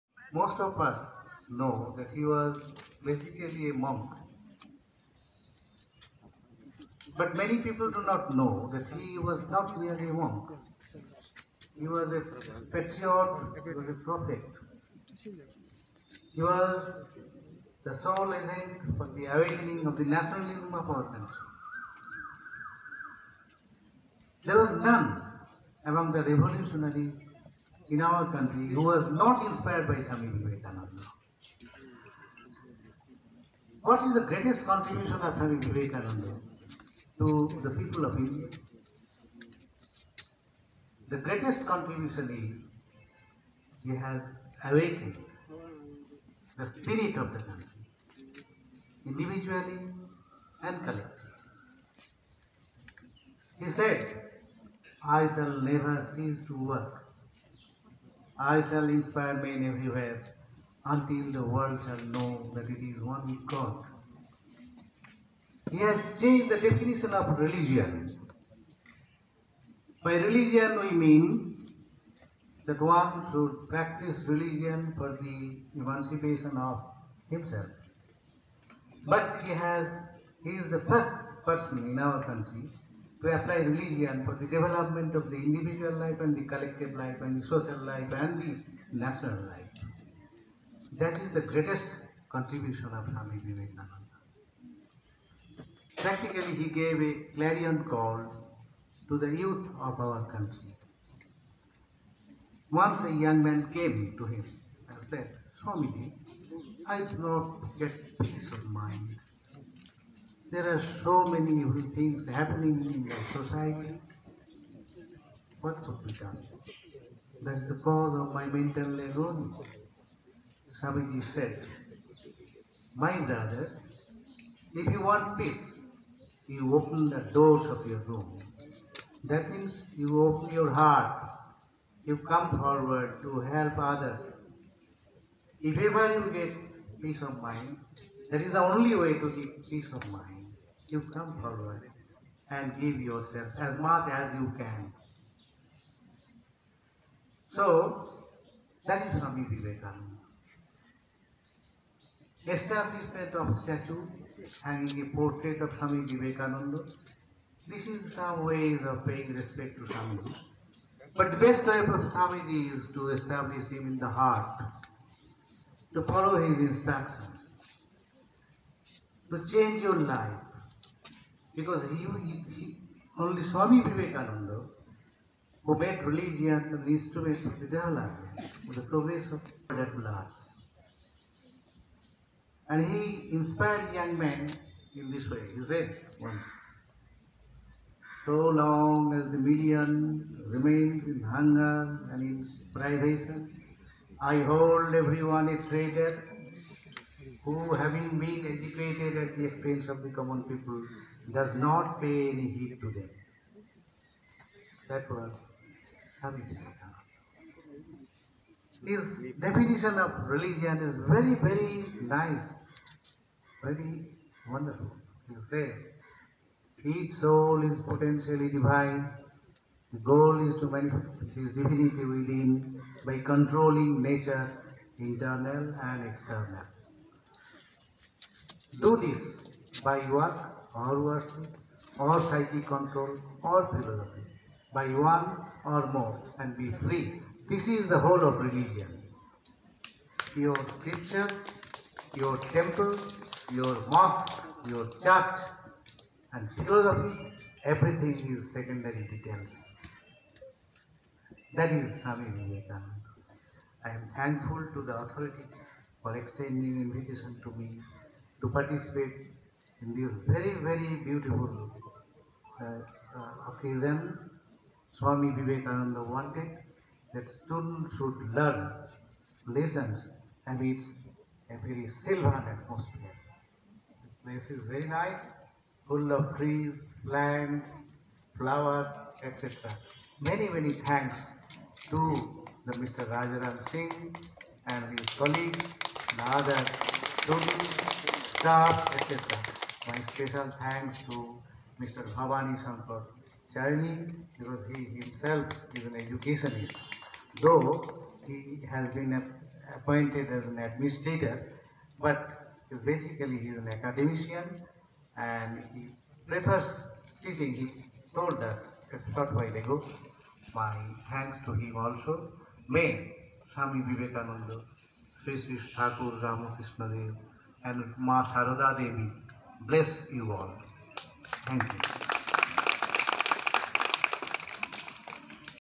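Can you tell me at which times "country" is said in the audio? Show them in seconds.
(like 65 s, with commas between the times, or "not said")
21 s, 28 s, 47 s, 82 s, 100 s.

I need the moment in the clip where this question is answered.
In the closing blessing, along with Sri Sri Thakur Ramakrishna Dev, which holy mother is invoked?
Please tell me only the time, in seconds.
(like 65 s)
317 s.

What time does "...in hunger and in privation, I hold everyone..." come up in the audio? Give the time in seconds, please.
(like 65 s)
191 s.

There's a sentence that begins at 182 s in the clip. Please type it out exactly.
And he inspired young men in this way.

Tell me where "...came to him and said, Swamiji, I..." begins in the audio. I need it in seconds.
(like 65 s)
103 s.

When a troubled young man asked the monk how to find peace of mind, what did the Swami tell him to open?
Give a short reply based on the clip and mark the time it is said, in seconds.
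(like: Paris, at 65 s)
the doors of your room, at 127 s.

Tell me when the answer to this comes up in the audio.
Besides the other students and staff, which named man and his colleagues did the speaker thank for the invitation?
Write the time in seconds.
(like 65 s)
283 s.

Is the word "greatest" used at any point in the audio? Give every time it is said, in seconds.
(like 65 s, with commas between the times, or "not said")
34 s, 41 s, 91 s.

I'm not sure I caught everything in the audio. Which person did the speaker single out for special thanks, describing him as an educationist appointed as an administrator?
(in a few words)
Bhavani Shankar Chaini.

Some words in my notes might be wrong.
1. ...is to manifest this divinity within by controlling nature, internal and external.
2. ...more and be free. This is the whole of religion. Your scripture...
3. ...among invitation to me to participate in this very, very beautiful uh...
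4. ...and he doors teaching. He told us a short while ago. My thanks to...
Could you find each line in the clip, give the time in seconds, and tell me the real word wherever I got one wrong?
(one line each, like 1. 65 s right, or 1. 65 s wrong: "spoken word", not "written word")
1. 220 s right
2. 235 s right
3. 256 s wrong: "extending", not "among"
4. 305 s wrong: "prefers", not "doors".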